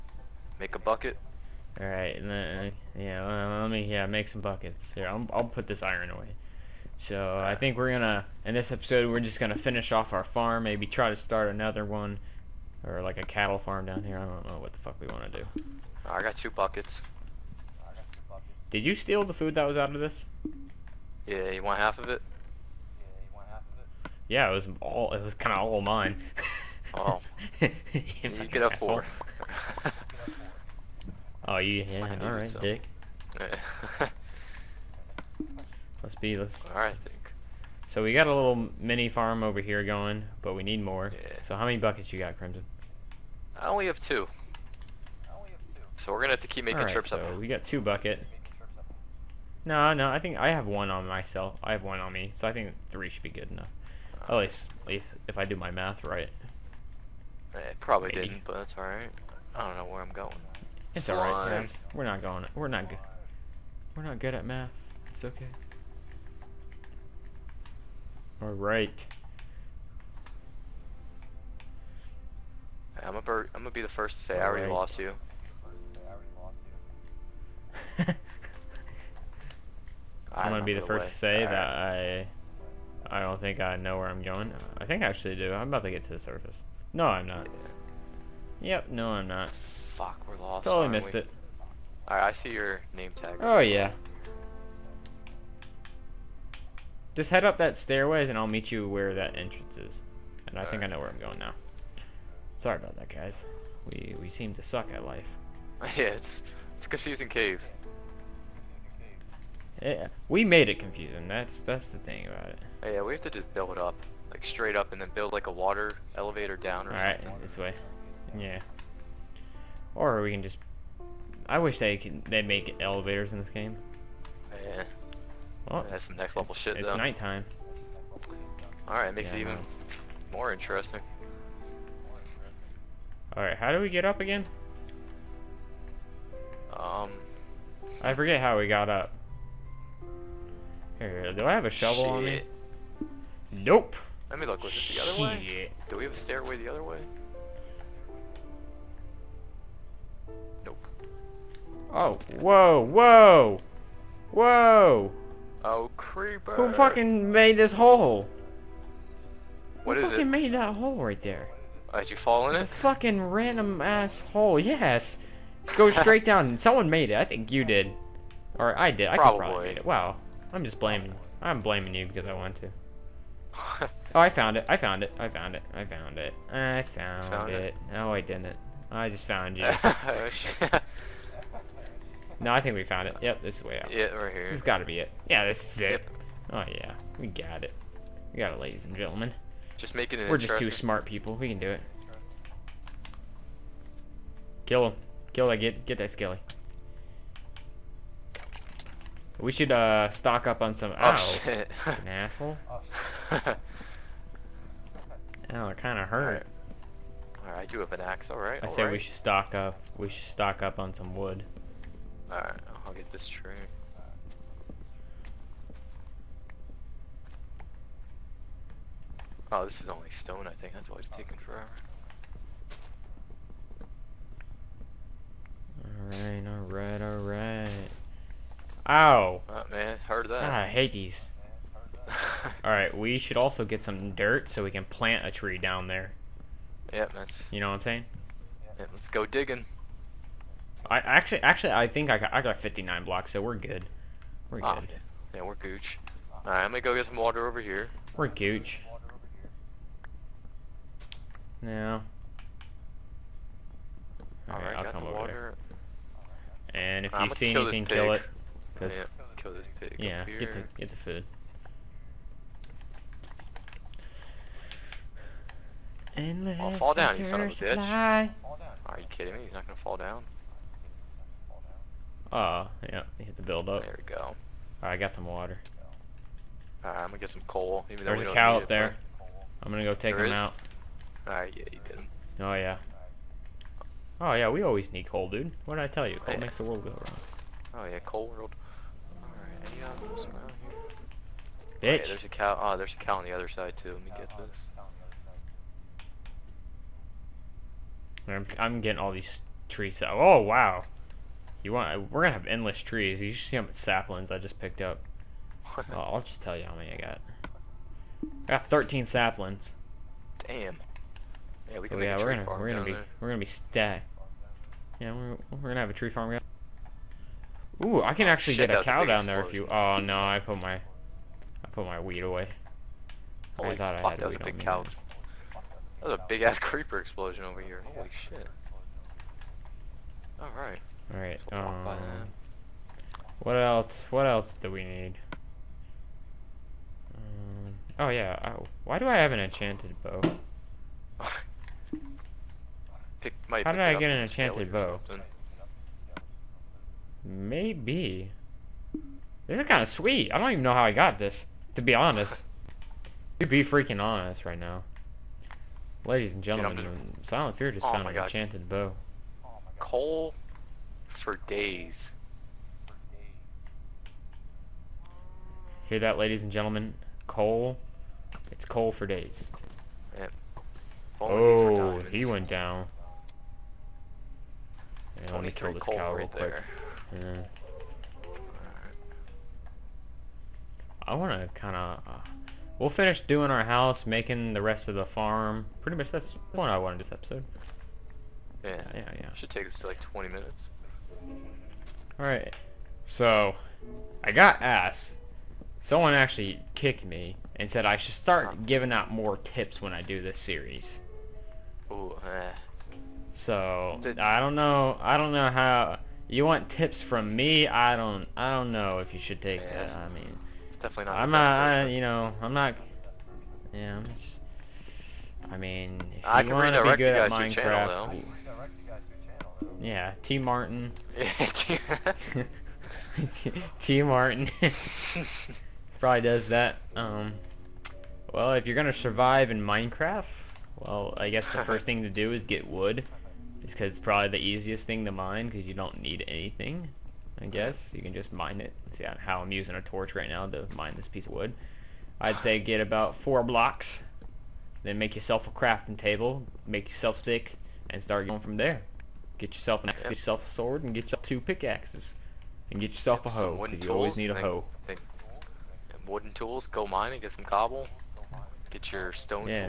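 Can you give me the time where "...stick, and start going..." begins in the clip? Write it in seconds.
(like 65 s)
447 s.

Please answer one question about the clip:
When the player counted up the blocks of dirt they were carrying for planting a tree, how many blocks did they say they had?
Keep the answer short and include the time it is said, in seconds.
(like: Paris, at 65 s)
59, at 242 s.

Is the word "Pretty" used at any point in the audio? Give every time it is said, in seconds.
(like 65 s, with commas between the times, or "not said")
385 s.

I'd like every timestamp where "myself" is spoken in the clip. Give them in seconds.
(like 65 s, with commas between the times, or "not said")
51 s.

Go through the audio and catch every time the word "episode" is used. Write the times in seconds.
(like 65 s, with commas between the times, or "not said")
8 s, 387 s.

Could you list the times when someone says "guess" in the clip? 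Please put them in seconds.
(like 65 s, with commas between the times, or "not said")
431 s, 437 s.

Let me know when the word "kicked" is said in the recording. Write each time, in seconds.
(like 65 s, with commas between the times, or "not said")
396 s.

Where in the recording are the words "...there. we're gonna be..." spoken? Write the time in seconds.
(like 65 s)
312 s.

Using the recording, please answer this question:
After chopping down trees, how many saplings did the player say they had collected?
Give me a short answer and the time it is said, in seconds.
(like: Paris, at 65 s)
13, at 308 s.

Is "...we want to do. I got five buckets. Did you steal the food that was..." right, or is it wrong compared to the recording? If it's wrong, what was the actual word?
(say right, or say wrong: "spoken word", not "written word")
wrong: "two", not "five".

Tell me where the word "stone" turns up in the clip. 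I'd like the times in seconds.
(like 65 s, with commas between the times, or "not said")
220 s, 459 s.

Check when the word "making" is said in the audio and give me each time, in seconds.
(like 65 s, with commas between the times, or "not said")
46 s, 189 s, 384 s.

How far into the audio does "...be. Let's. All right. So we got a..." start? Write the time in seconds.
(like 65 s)
36 s.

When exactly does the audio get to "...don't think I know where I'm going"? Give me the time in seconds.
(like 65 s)
83 s.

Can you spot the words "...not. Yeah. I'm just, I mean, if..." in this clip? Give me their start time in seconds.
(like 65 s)
412 s.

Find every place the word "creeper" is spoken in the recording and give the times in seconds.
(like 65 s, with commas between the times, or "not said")
155 s, 326 s.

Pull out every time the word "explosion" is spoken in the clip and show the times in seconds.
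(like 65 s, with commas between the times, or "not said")
319 s, 326 s.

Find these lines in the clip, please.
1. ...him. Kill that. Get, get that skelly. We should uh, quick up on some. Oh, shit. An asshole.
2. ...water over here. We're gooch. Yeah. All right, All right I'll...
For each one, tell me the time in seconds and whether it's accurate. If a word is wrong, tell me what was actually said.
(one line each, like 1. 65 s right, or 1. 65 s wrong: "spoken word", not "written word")
1. 194 s wrong: "stock", not "quick"
2. 247 s right.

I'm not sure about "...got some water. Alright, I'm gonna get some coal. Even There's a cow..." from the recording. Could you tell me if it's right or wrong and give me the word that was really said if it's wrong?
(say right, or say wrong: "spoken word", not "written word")
right.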